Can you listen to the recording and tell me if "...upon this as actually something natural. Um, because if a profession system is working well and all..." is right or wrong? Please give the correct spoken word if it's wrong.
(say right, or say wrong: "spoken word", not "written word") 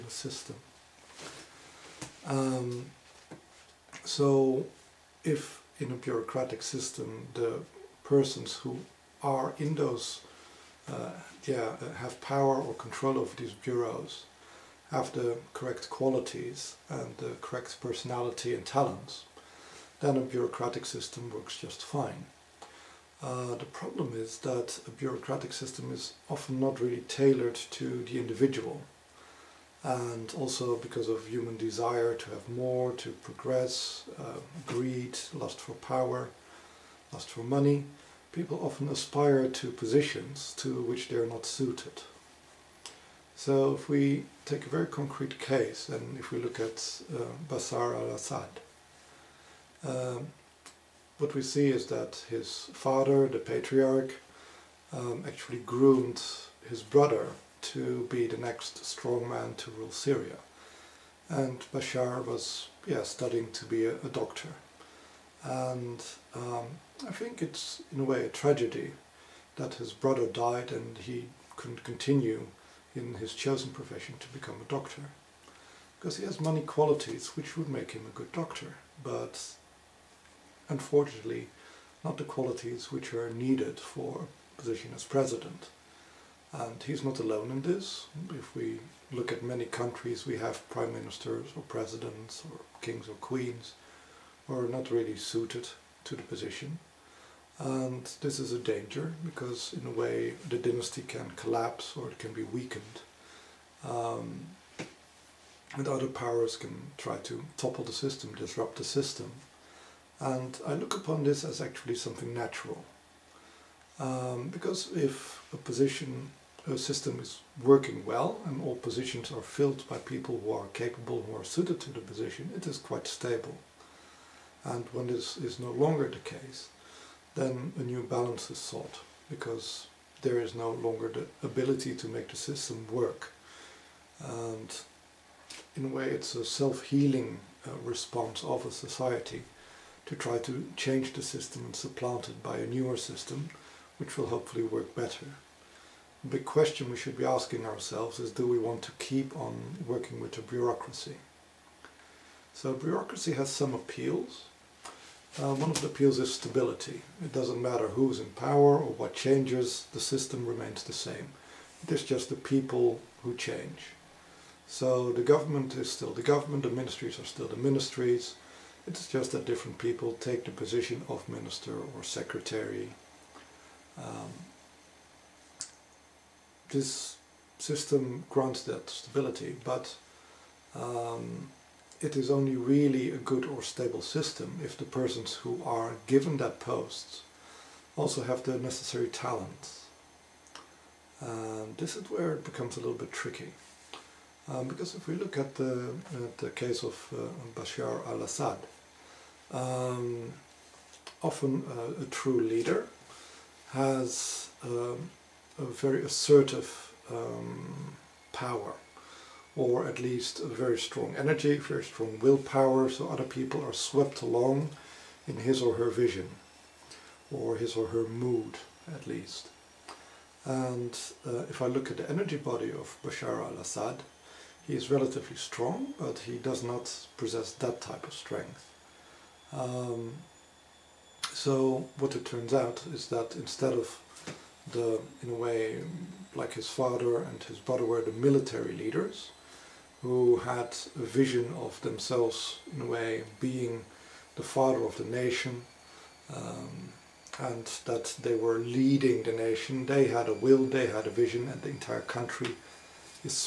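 wrong: "position", not "profession".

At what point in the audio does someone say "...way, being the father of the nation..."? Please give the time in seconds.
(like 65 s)
242 s.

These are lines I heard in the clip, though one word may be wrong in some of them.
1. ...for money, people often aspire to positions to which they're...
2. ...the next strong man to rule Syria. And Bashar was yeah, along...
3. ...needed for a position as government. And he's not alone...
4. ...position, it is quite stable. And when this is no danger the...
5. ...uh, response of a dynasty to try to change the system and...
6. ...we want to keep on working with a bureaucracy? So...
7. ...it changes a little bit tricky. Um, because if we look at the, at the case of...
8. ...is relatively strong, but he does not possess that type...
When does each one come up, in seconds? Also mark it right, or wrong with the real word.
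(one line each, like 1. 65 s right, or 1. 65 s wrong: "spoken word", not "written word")
1. 37 s right
2. 58 s wrong: "studying", not "along"
3. 83 s wrong: "president", not "government"
4. 122 s wrong: "longer", not "danger"
5. 137 s wrong: "society", not "dynasty"
6. 148 s right
7. 192 s wrong: "becomes", not "changes"
8. 224 s right.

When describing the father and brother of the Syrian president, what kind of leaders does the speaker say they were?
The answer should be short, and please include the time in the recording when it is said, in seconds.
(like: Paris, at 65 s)
military leaders, at 238 s.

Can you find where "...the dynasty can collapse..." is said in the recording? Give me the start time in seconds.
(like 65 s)
100 s.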